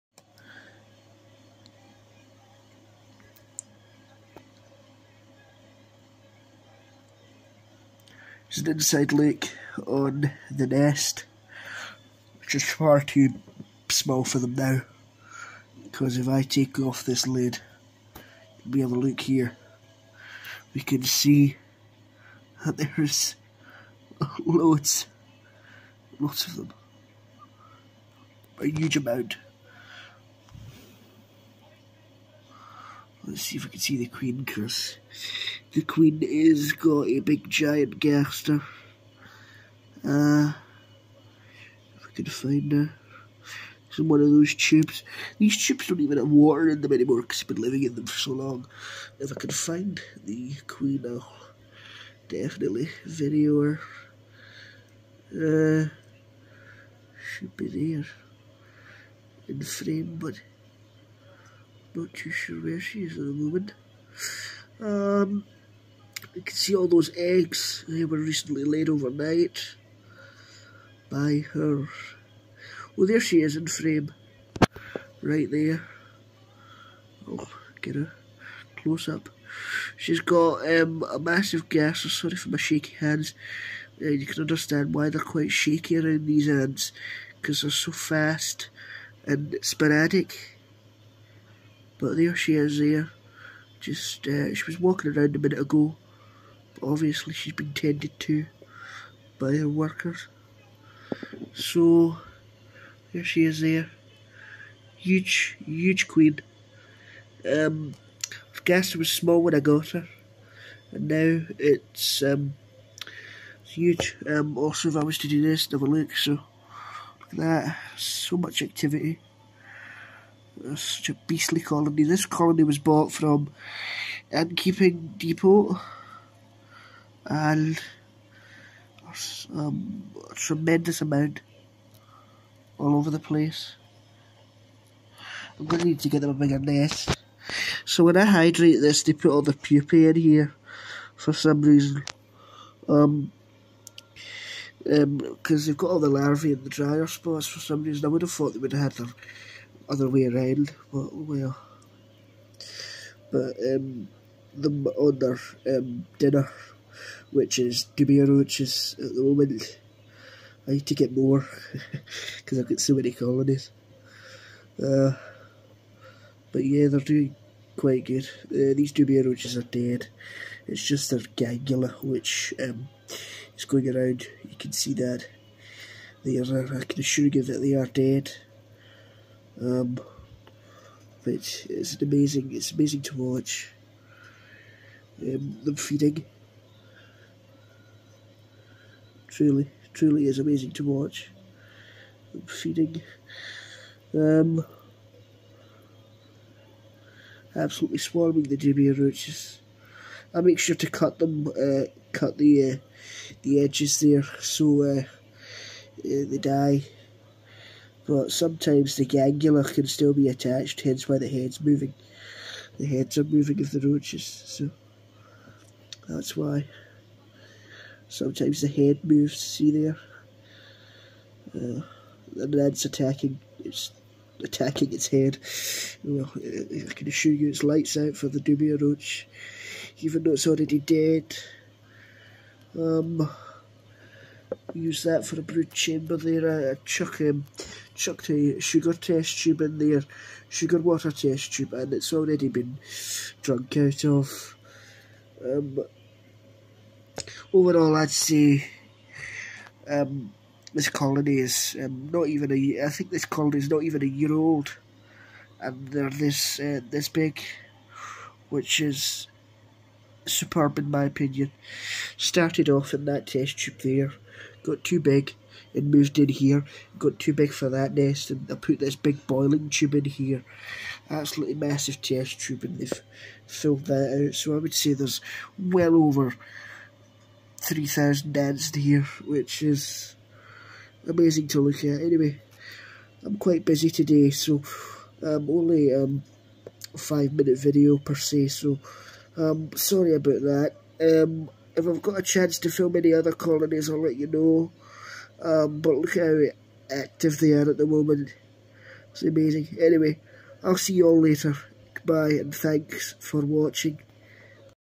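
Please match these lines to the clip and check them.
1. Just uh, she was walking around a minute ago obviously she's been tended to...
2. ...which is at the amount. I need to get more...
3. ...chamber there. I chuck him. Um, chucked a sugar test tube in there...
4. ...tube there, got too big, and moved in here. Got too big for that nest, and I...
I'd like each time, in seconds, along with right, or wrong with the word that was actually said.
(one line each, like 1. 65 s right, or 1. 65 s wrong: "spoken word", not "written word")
1. 93 s right
2. 158 s wrong: "moment", not "amount"
3. 235 s right
4. 263 s right.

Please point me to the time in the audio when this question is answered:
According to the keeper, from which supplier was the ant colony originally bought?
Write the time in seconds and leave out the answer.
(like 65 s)
124 s.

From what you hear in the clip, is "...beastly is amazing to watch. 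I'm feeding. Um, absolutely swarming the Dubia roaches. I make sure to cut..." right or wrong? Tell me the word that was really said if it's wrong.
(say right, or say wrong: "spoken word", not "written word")
wrong: "truly", not "beastly".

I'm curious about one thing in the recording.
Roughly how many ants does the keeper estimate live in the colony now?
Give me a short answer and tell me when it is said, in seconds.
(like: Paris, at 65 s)
over 3,000, at 275 s.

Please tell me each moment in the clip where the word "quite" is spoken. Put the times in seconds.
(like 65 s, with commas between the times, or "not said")
85 s, 167 s, 283 s.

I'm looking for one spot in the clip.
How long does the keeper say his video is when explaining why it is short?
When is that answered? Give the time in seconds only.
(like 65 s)
286 s.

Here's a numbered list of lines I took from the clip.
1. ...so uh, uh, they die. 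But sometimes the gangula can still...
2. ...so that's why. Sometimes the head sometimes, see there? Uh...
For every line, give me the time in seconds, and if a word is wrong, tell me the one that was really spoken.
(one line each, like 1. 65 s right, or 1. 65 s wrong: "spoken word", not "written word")
1. 204 s right
2. 214 s wrong: "moves", not "sometimes".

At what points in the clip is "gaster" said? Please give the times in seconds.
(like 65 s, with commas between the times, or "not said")
37 s.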